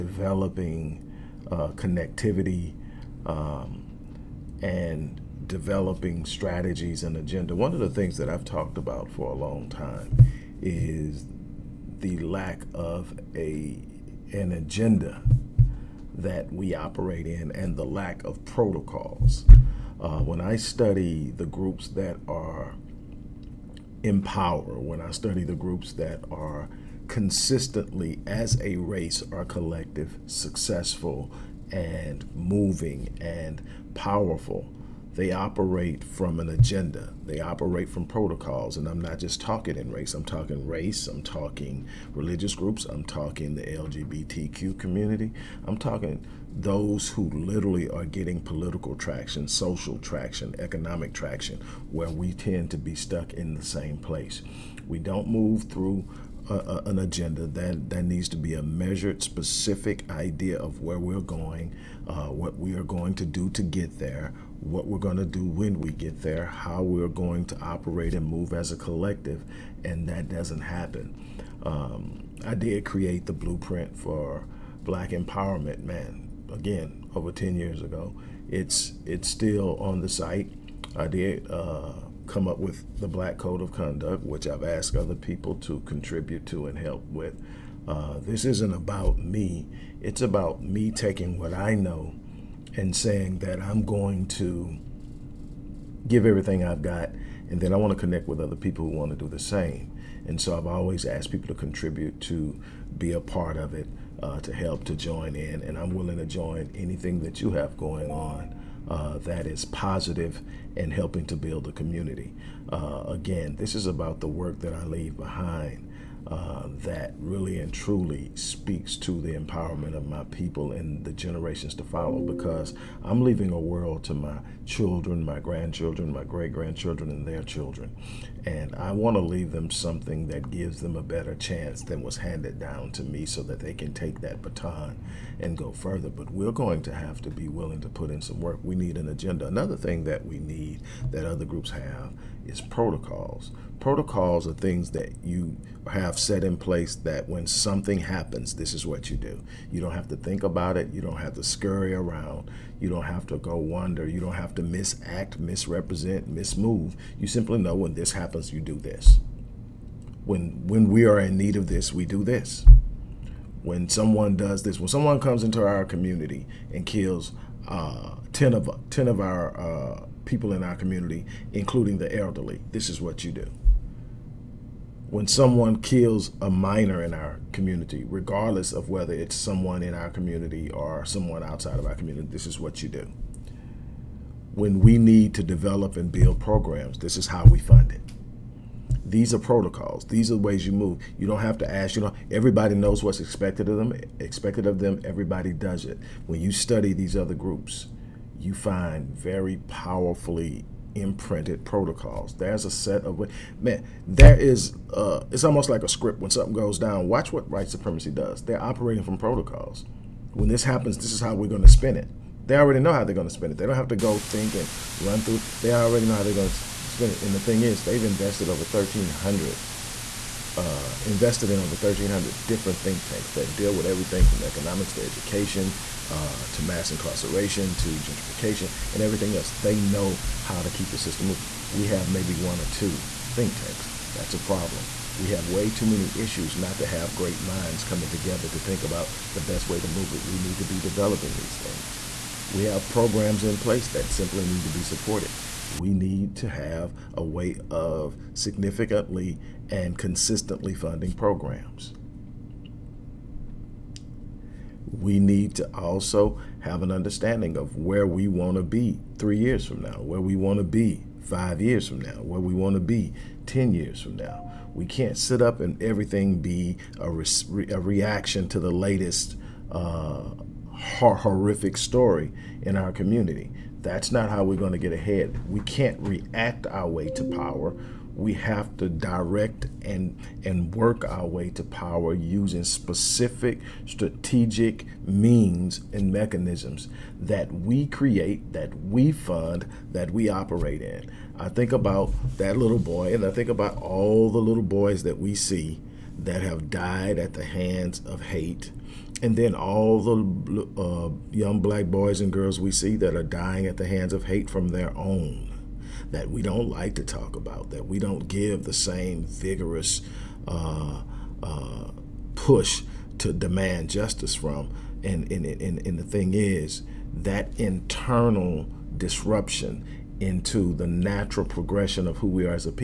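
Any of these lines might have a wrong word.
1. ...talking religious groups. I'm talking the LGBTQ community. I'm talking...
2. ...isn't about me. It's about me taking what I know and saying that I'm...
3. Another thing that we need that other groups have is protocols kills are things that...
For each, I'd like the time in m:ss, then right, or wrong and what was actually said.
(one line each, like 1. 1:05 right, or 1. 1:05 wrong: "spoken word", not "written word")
1. 0:41 right
2. 1:28 right
3. 2:19 wrong: "protocols", not "kills".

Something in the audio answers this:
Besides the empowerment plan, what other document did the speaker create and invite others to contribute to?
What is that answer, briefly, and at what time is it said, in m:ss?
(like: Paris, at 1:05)
Black Code of Conduct, at 1:23.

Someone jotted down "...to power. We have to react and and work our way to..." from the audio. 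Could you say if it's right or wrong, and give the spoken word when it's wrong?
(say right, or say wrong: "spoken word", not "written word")
wrong: "direct", not "react".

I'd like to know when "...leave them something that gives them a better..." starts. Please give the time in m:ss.
2:09.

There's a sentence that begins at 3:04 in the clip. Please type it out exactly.
When we need to develop and build programs, this is how we fund it.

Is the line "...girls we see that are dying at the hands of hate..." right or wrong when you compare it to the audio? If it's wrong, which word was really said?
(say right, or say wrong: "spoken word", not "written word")
right.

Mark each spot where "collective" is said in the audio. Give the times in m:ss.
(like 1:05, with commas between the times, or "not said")
0:29, 1:08.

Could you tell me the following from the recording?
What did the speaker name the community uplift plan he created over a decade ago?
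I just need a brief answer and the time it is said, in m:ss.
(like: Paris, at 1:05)
Blueprint for Black Empowerment, at 1:13.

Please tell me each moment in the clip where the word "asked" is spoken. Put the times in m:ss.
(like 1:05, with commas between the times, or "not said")
1:24, 1:41.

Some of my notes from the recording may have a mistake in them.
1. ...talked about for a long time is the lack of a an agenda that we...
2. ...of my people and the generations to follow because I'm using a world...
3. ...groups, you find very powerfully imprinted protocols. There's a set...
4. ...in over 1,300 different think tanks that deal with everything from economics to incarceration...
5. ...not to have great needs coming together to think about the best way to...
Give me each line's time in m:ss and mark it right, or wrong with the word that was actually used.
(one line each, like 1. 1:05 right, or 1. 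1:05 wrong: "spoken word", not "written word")
1. 0:08 right
2. 1:59 wrong: "leaving", not "using"
3. 3:17 right
4. 3:41 wrong: "education", not "incarceration"
5. 3:56 wrong: "minds", not "needs".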